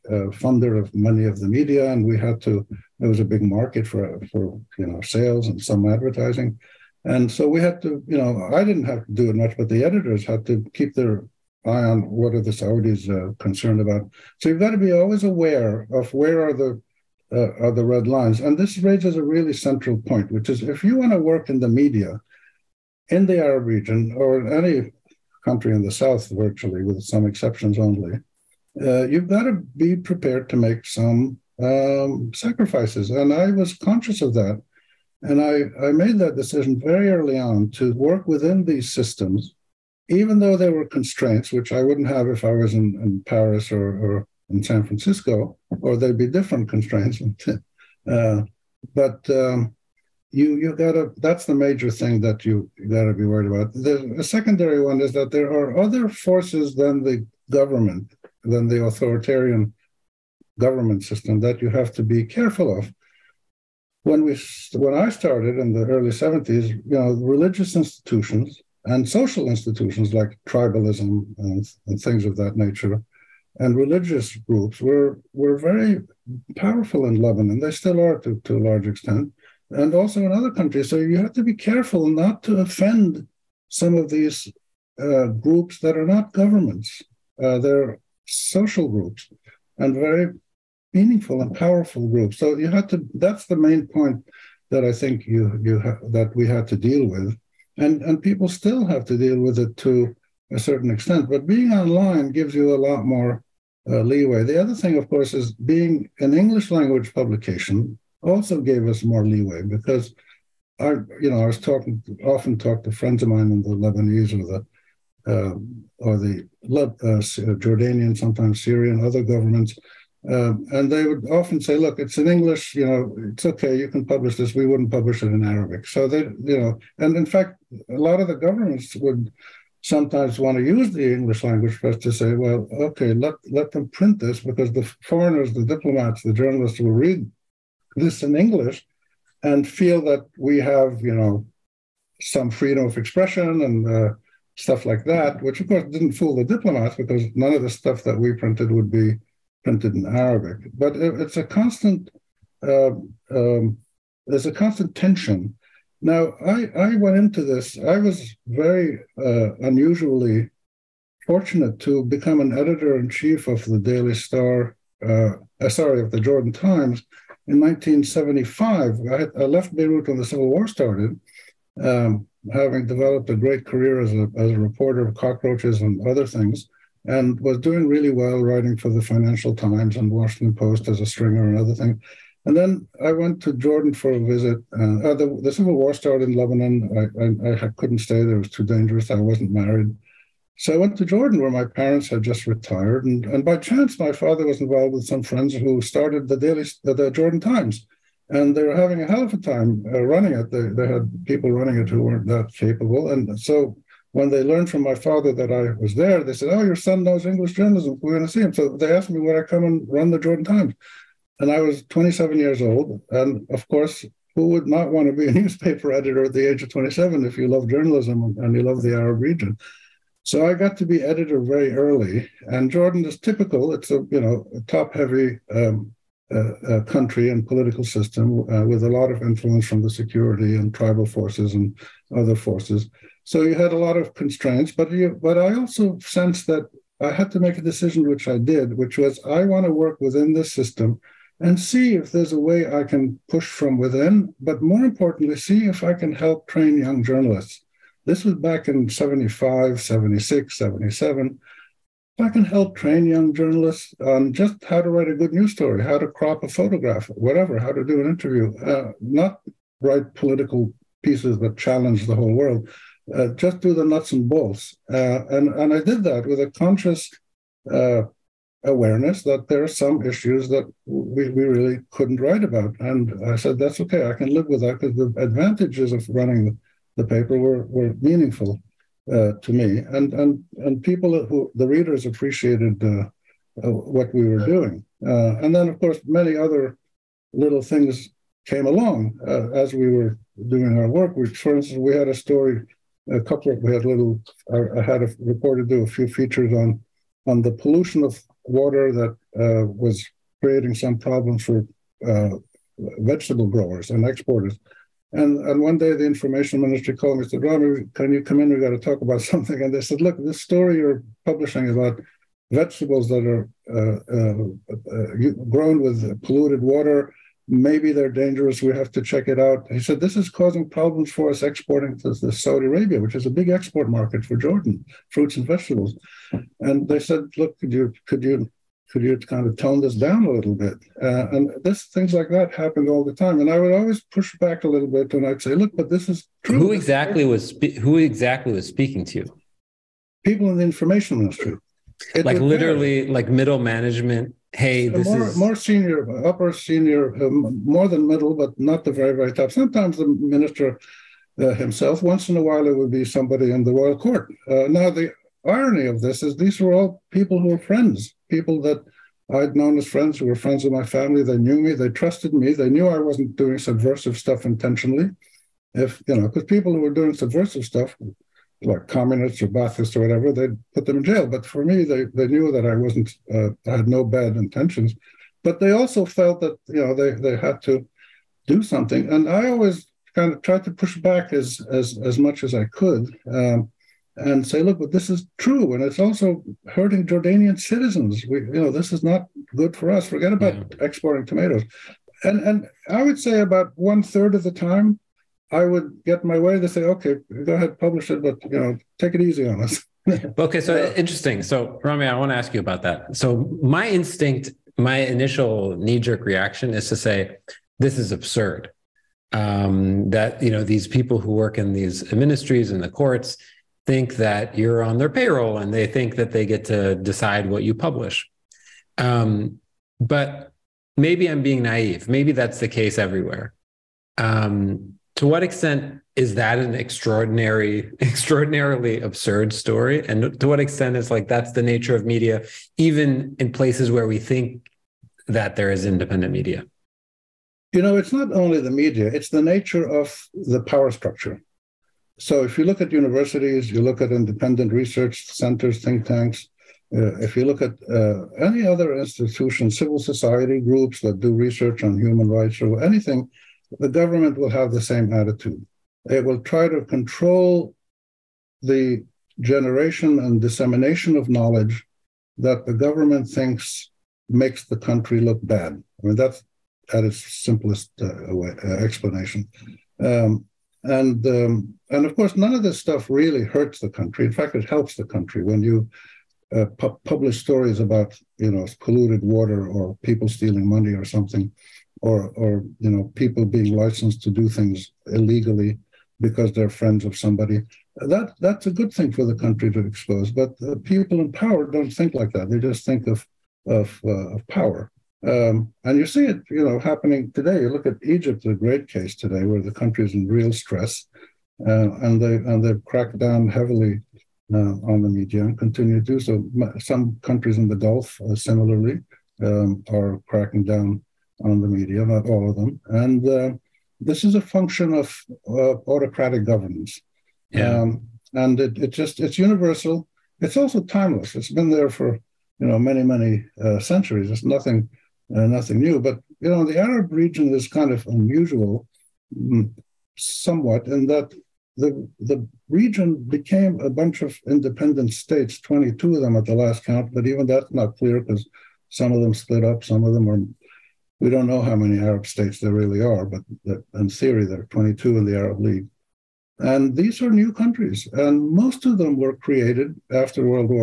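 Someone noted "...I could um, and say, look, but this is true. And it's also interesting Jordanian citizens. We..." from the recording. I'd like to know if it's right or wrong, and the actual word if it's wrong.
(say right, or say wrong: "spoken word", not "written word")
wrong: "hurting", not "interesting".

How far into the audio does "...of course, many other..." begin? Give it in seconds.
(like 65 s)
285 s.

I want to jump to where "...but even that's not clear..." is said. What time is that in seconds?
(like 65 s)
537 s.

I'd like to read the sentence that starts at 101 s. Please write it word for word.
But being online gives you a lot more uh, leeway.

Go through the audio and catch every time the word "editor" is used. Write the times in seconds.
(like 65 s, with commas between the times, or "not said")
9 s, 162 s, 215 s, 221 s.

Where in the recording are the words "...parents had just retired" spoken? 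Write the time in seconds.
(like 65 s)
191 s.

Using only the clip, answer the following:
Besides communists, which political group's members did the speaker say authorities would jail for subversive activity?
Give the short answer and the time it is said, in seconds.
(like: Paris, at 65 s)
Baathists, at 369 s.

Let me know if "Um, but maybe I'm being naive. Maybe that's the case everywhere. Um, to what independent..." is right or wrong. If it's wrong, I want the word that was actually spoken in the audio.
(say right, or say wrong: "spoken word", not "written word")
wrong: "extent", not "independent".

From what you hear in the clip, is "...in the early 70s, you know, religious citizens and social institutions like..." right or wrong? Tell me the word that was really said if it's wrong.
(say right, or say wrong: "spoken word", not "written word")
wrong: "institutions", not "citizens".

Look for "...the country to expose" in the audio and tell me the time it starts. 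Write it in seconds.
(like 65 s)
489 s.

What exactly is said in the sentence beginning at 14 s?
So you've got to be always aware of where are the uh, are the red lines.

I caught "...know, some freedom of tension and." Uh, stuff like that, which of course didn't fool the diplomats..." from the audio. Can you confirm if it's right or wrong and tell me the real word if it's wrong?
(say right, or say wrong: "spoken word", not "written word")
wrong: "expression", not "tension".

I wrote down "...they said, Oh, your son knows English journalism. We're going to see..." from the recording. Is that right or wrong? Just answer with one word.
right.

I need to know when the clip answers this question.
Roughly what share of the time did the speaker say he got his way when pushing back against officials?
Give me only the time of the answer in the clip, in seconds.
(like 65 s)
393 s.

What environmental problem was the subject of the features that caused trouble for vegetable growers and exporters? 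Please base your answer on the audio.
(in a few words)
pollution of water.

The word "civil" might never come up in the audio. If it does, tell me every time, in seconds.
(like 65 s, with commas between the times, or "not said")
170 s, 185 s, 449 s.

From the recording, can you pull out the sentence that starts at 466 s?
I mean, that's at its simplest uh, way, uh, explanation.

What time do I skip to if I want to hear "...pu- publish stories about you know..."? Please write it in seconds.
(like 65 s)
476 s.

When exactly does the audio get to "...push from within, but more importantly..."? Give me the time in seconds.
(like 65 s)
243 s.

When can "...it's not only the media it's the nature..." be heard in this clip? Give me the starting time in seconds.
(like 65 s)
437 s.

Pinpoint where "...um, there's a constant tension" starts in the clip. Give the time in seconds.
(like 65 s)
153 s.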